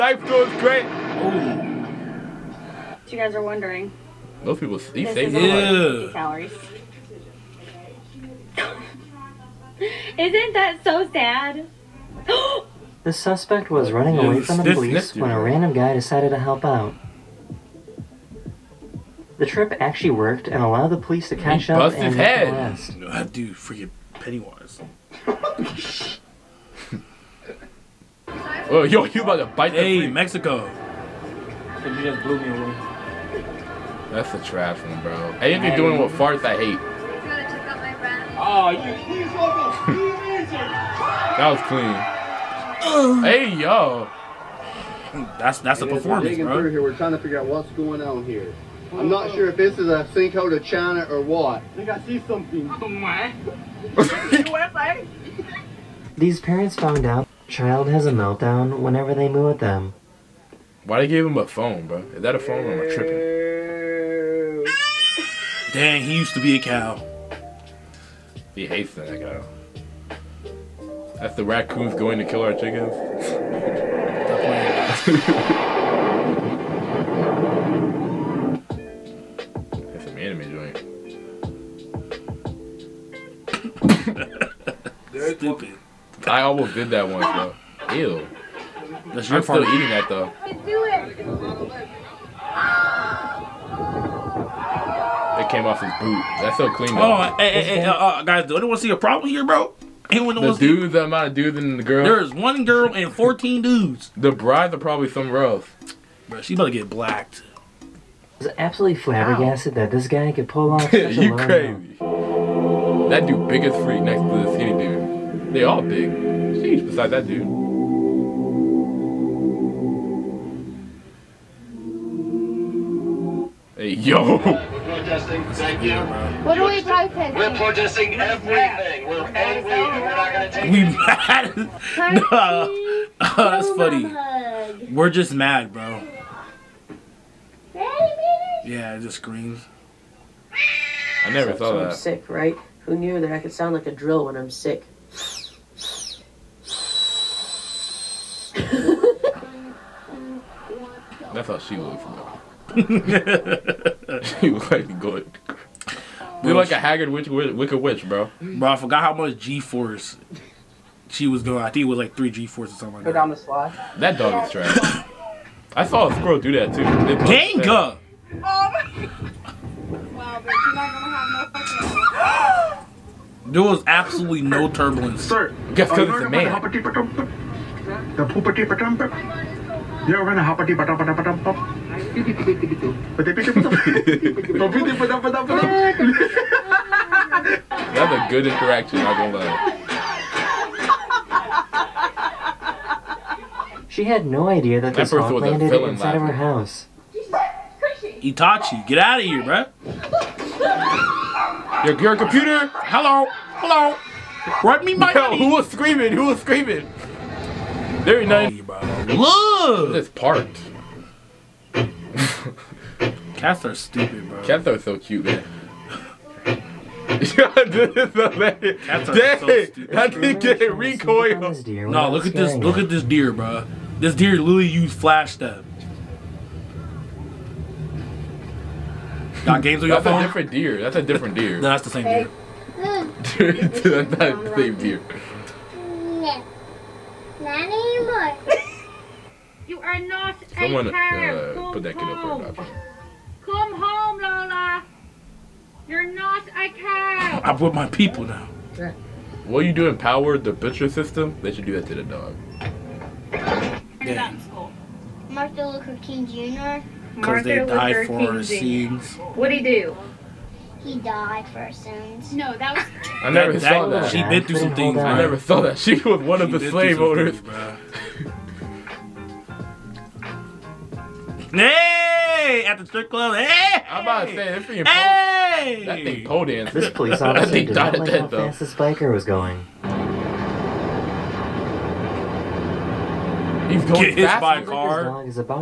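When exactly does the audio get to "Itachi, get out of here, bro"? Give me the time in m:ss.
3:18.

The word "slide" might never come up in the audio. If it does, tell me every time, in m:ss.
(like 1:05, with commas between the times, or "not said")
2:43.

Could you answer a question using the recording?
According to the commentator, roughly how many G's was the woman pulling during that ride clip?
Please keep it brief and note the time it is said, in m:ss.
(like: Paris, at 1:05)
3, at 2:42.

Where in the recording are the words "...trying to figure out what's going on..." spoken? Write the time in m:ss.
0:46.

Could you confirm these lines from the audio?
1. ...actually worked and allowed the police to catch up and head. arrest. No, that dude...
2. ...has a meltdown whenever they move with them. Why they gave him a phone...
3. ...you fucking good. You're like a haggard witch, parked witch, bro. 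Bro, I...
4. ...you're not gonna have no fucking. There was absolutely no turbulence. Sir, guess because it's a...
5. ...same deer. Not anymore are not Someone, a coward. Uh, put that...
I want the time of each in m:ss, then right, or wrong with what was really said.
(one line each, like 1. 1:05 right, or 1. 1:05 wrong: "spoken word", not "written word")
1. 0:19 right
2. 0:57 right
3. 2:34 wrong: "wicked", not "parked"
4. 2:50 right
5. 3:54 right.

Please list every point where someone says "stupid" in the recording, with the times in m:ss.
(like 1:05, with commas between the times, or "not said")
1:25, 3:33, 3:39.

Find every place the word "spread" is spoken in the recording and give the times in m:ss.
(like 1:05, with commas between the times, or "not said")
not said.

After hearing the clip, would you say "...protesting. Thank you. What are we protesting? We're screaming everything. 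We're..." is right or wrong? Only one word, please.
wrong.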